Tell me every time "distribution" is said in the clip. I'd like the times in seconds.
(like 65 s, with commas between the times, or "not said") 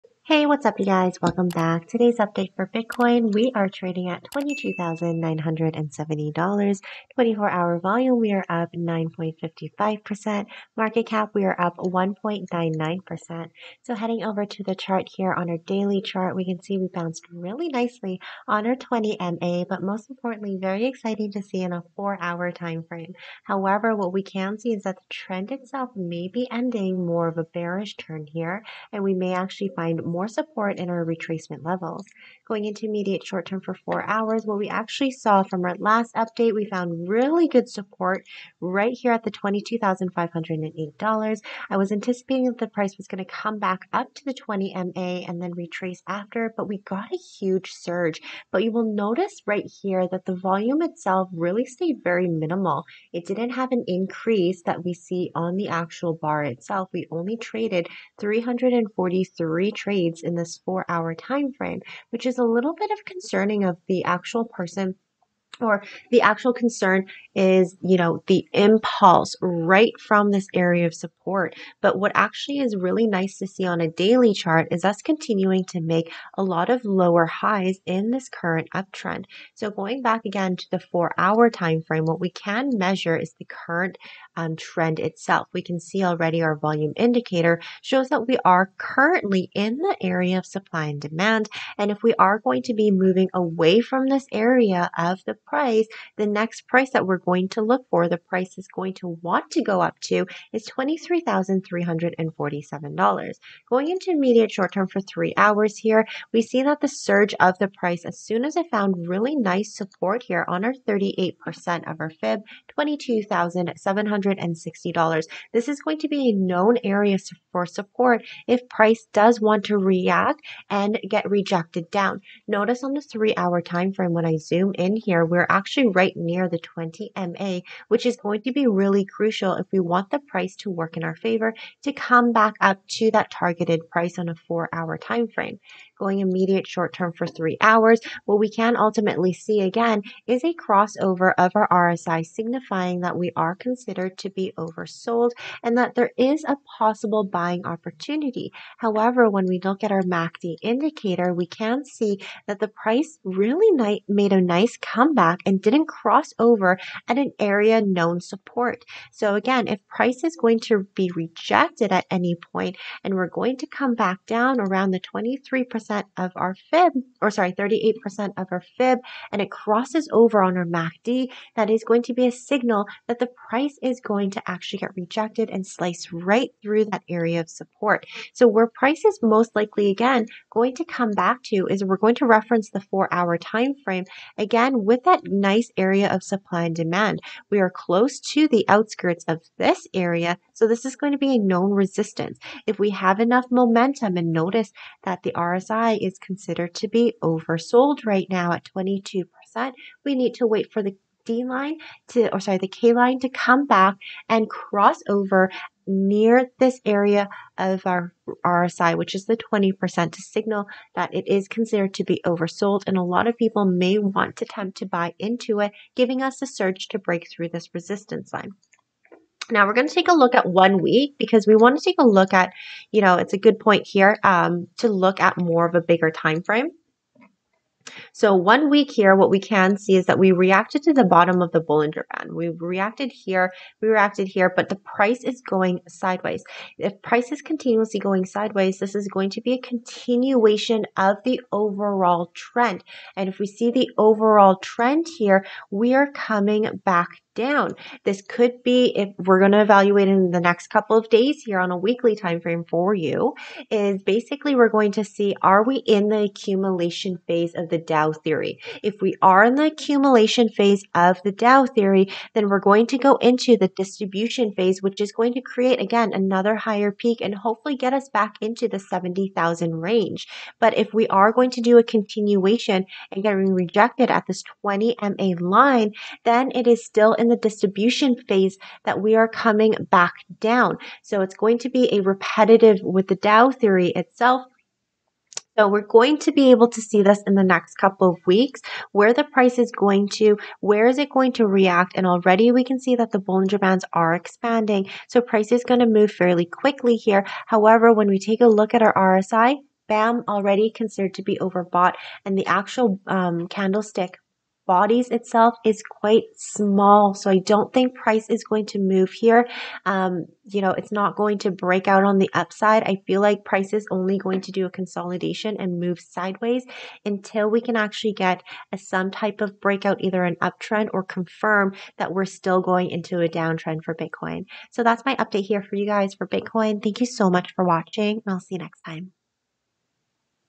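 263 s, 277 s.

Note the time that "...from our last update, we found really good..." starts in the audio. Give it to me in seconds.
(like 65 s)
35 s.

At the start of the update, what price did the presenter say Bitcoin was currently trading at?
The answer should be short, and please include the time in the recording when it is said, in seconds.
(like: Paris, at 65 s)
$22,970, at 4 s.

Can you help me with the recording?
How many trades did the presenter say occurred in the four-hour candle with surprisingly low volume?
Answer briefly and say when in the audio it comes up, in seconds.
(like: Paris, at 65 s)
343, at 58 s.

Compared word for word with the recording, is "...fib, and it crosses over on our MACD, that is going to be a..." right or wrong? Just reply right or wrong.
right.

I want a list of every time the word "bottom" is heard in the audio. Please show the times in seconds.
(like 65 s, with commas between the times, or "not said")
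231 s.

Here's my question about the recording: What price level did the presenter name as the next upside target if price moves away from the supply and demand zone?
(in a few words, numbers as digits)
$23,347.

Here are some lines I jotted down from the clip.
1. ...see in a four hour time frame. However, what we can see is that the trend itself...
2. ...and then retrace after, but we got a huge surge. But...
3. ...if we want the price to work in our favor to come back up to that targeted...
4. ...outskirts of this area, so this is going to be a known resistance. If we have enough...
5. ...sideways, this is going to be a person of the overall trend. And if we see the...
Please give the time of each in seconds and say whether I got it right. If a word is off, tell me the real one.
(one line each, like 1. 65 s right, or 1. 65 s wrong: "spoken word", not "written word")
1. 21 s right
2. 45 s right
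3. 129 s right
4. 188 s right
5. 238 s wrong: "continuation", not "person".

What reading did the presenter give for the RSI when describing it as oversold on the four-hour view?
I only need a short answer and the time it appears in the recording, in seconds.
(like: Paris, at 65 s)
22%, at 198 s.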